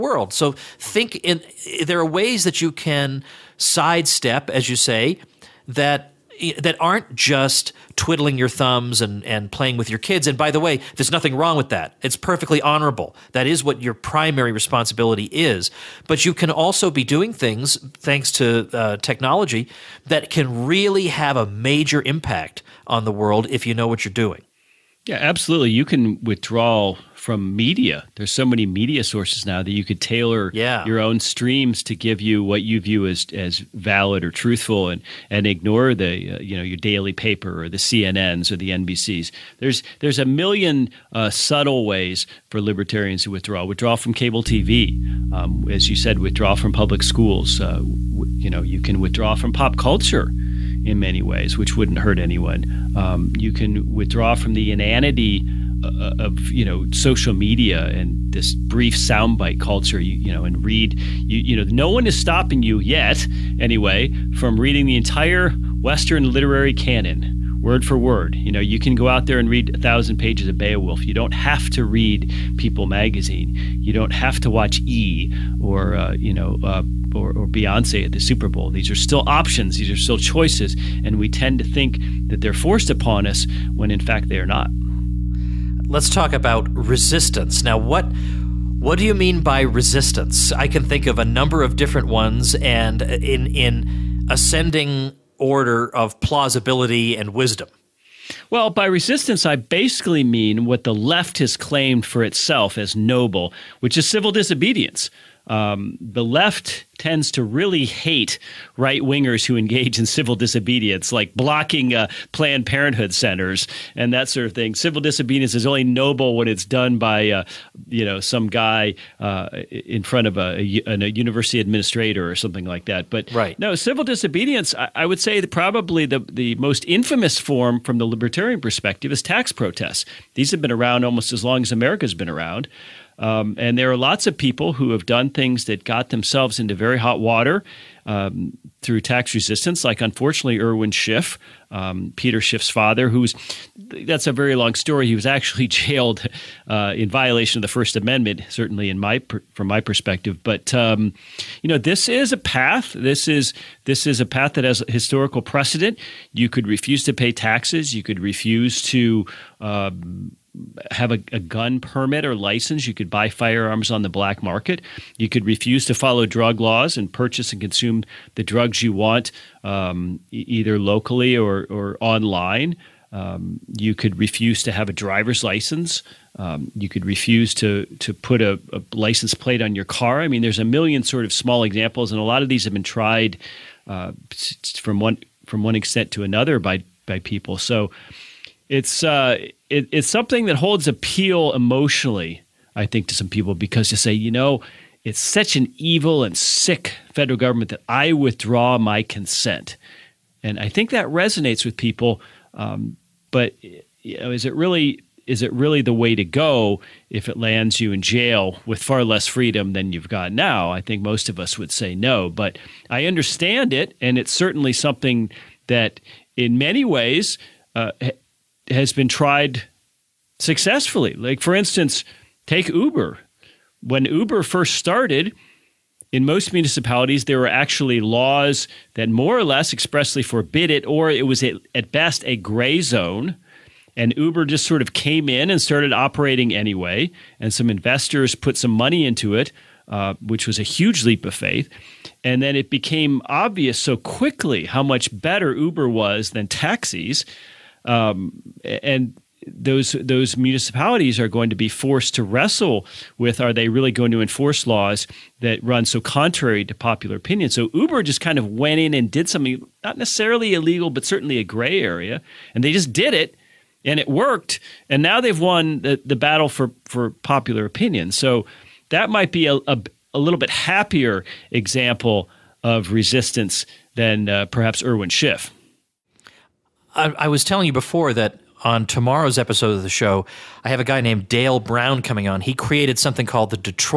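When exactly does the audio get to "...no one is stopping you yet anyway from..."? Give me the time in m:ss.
1:01.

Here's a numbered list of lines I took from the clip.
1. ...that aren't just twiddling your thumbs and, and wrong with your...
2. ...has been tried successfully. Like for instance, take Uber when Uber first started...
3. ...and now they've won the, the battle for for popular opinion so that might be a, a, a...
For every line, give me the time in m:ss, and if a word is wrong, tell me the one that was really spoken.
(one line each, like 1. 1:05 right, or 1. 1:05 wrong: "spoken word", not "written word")
1. 0:06 wrong: "playing", not "wrong"
2. 3:38 right
3. 4:24 right.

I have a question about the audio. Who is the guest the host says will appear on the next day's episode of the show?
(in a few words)
Dale Brown.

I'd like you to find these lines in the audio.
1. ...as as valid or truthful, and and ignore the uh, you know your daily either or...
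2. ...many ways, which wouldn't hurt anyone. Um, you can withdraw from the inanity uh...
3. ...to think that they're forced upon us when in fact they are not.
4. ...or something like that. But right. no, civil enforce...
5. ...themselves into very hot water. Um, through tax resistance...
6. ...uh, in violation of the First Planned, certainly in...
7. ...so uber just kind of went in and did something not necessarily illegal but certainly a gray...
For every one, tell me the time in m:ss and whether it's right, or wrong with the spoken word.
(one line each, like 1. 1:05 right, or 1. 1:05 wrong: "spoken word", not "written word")
1. 0:33 wrong: "paper", not "either"
2. 0:50 right
3. 1:21 right
4. 2:02 wrong: "disobedience", not "enforce"
5. 2:16 right
6. 2:26 wrong: "Amendment", not "Planned"
7. 4:17 right.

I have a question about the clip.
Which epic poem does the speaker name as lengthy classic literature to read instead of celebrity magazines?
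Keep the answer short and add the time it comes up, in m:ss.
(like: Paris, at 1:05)
Beowulf, at 1:10.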